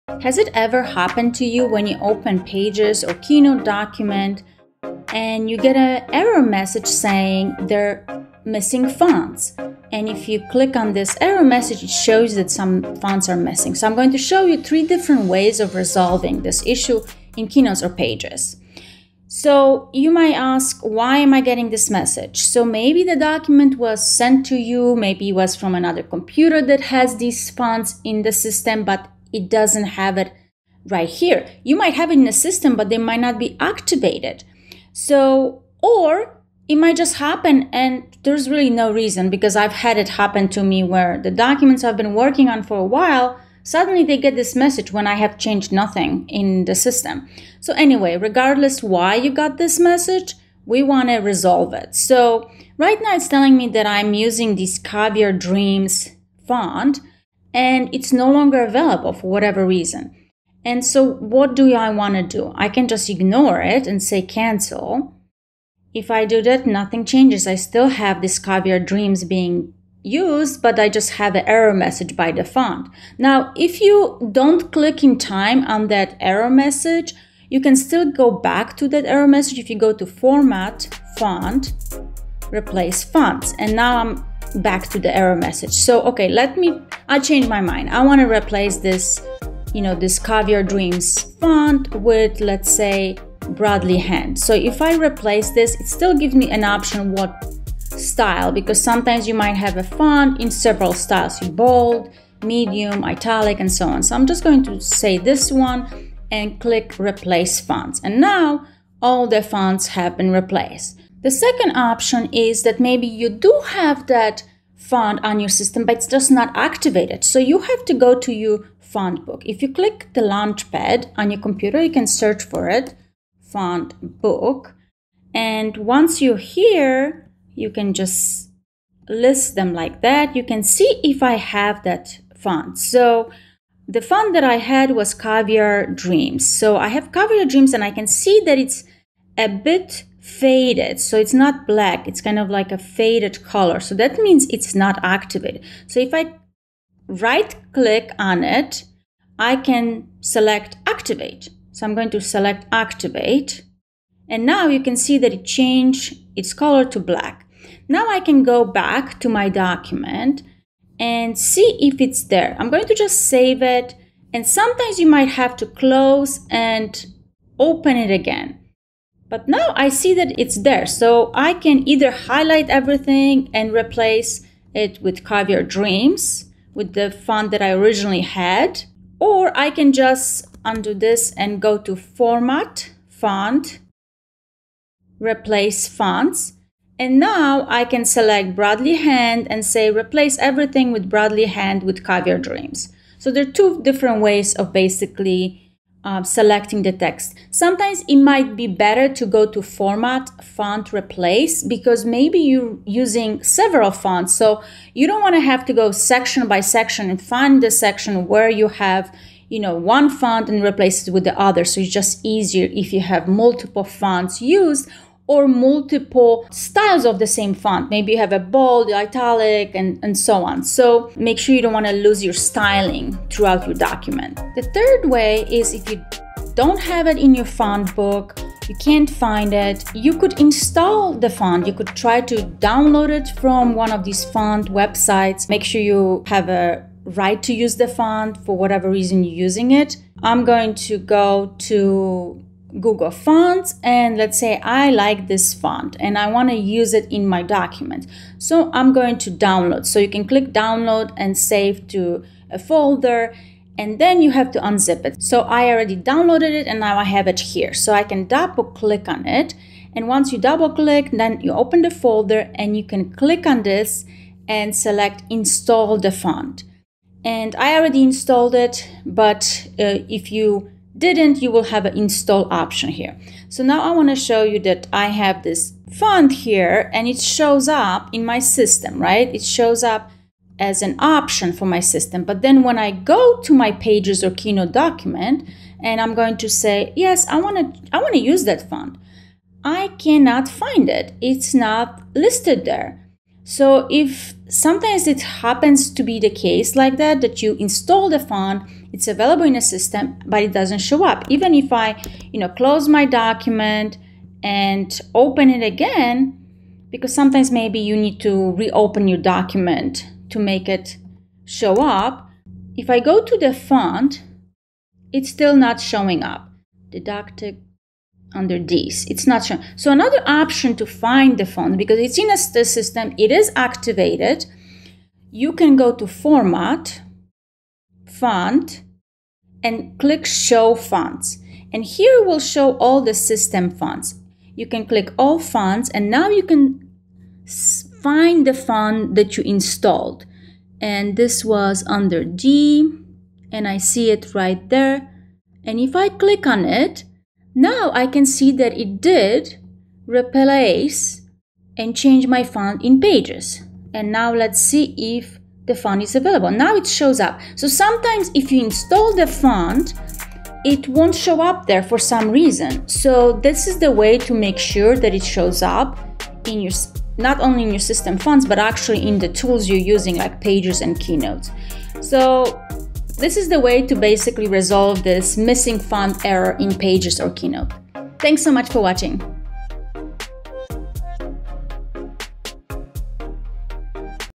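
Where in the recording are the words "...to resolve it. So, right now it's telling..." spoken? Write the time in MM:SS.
00:51.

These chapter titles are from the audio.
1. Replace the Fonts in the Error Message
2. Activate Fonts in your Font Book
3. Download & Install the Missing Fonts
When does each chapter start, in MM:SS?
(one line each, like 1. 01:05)
1. 01:30
2. 01:54
3. 03:46.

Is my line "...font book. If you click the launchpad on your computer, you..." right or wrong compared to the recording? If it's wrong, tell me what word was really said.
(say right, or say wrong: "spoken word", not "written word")
right.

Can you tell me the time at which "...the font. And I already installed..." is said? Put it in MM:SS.
04:25.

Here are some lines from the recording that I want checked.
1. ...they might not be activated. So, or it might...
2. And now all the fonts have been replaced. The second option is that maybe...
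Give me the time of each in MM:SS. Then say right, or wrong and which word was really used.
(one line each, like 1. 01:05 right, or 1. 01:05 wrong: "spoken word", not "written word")
1. 00:32 right
2. 01:48 right.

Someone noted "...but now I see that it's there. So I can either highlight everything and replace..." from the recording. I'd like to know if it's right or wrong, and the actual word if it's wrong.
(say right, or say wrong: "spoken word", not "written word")
right.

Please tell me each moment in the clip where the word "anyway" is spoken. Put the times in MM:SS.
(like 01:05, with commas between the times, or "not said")
00:47.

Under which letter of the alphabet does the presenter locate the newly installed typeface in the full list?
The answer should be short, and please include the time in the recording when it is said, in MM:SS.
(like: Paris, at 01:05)
G, at 05:42.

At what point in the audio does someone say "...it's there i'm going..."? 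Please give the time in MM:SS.
02:41.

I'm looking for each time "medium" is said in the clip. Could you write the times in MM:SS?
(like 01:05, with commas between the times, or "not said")
01:42.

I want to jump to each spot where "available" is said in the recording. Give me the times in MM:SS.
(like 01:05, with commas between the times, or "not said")
00:58, 04:59, 05:56.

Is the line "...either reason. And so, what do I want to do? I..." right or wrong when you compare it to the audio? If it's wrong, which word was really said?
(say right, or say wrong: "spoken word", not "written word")
wrong: "whatever", not "either".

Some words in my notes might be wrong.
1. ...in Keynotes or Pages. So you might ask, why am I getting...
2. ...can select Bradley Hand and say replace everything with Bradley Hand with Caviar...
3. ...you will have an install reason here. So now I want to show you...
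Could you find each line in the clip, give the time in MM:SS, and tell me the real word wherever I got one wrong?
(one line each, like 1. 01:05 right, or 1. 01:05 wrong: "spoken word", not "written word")
1. 00:17 right
2. 03:07 right
3. 04:31 wrong: "option", not "reason".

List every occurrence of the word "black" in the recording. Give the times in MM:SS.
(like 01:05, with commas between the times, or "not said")
02:21, 02:36.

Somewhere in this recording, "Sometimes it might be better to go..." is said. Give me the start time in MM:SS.
03:17.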